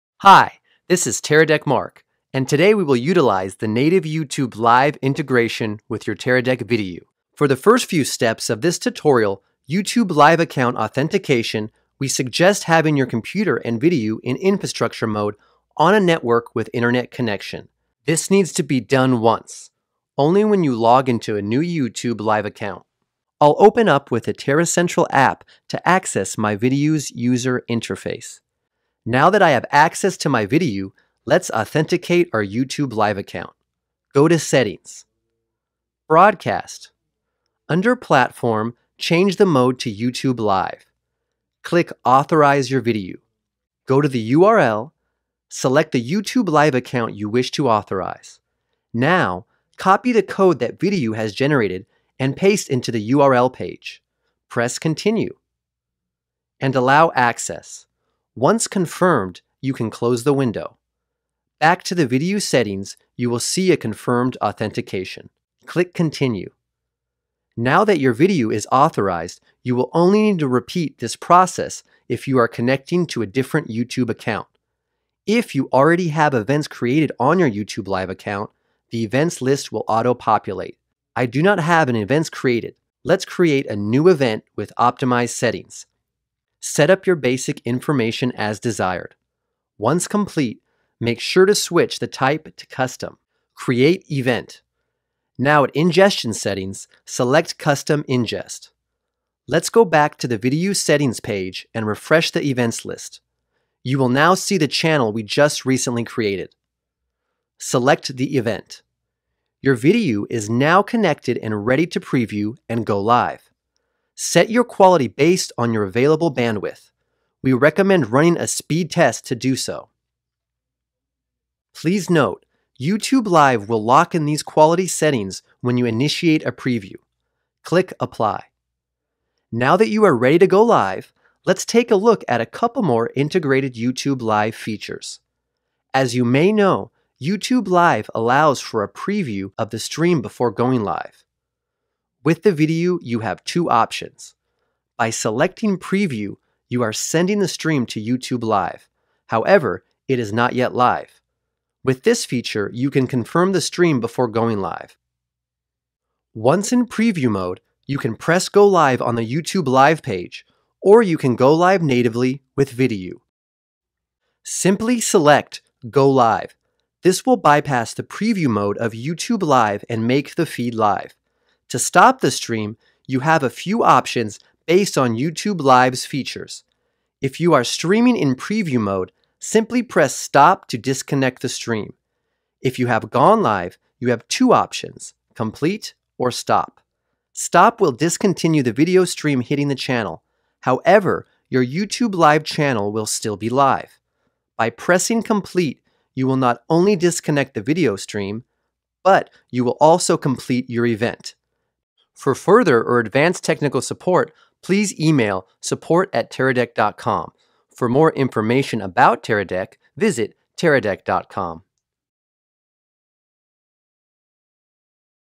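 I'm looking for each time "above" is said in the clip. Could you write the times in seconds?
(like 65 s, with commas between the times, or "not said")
not said.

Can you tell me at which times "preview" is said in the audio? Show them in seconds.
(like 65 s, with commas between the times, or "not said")
111 s, 126 s, 138 s, 145 s, 156 s, 168 s, 178 s.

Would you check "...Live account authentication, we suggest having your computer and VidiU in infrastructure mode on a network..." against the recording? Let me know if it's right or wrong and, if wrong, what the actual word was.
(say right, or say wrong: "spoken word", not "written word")
right.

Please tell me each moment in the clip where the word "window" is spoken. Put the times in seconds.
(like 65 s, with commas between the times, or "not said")
60 s.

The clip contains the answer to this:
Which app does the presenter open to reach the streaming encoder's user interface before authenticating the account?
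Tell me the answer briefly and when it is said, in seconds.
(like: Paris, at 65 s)
Terra Central, at 24 s.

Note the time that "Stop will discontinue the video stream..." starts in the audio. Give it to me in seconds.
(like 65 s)
187 s.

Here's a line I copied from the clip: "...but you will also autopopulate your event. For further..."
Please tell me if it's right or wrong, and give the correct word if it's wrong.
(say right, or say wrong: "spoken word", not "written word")
wrong: "complete", not "autopopulate".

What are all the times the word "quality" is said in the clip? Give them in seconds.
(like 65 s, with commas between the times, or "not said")
114 s, 124 s.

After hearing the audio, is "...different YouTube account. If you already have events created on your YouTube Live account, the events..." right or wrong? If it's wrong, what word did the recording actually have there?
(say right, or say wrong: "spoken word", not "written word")
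right.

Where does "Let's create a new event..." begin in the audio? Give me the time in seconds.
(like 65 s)
83 s.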